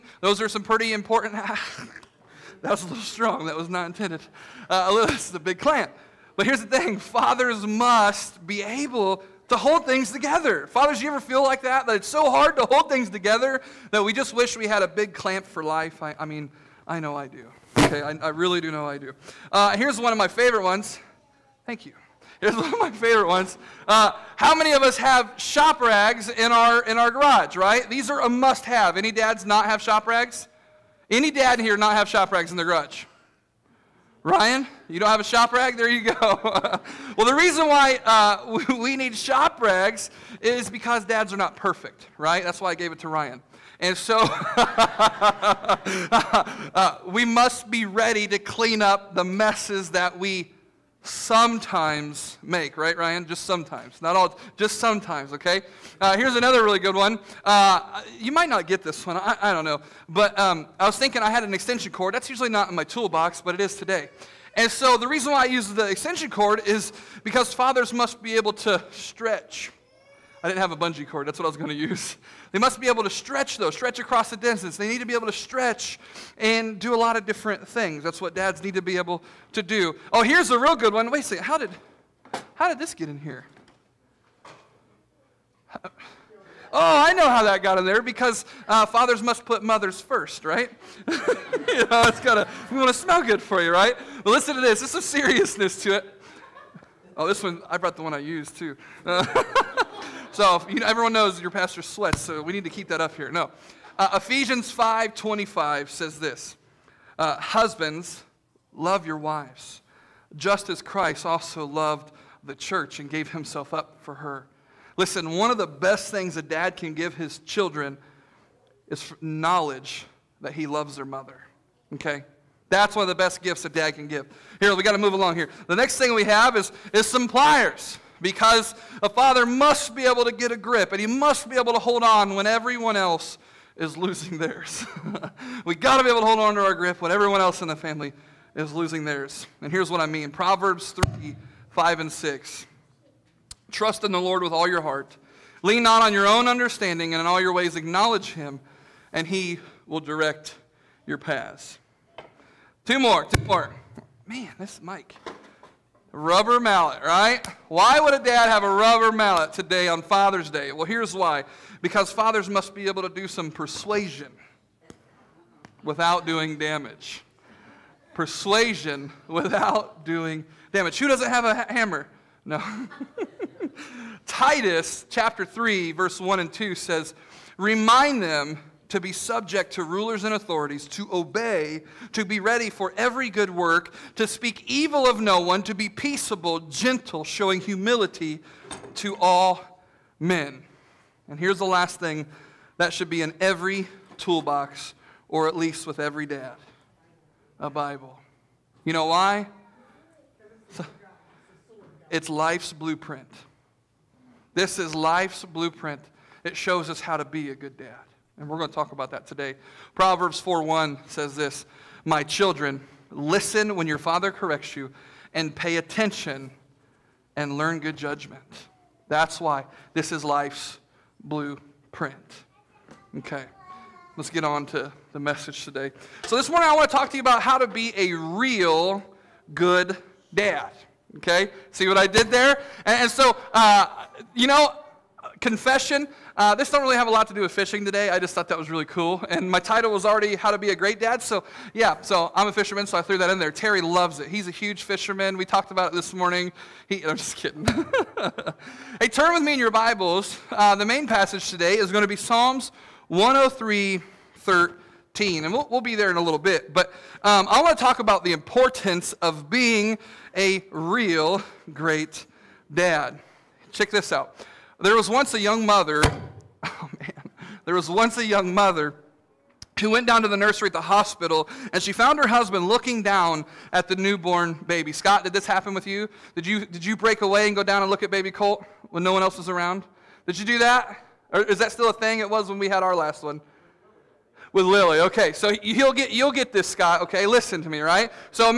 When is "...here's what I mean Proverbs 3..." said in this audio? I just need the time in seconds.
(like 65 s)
139 s.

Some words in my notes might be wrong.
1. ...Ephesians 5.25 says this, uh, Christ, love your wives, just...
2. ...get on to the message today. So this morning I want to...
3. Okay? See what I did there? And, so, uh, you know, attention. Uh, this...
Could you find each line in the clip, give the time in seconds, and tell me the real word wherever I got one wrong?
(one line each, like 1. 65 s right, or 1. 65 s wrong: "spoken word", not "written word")
1. 104 s wrong: "Husbands", not "Christ"
2. 224 s right
3. 231 s wrong: "confession", not "attention".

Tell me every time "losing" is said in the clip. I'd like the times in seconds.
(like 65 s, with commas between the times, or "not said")
133 s, 138 s.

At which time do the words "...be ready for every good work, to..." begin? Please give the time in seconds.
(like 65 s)
182 s.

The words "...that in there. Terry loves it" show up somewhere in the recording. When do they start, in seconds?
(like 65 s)
243 s.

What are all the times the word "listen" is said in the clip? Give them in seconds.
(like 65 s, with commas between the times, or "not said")
94 s, 114 s, 213 s, 287 s.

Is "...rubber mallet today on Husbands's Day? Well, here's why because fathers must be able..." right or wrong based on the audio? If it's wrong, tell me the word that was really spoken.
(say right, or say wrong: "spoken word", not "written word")
wrong: "Father", not "Husbands".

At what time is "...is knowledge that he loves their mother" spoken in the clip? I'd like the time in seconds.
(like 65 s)
118 s.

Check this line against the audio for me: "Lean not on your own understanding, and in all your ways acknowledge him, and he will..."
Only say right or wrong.
right.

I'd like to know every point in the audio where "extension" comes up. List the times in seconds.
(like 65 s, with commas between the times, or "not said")
61 s, 65 s.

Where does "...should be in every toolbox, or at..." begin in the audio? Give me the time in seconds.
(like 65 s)
192 s.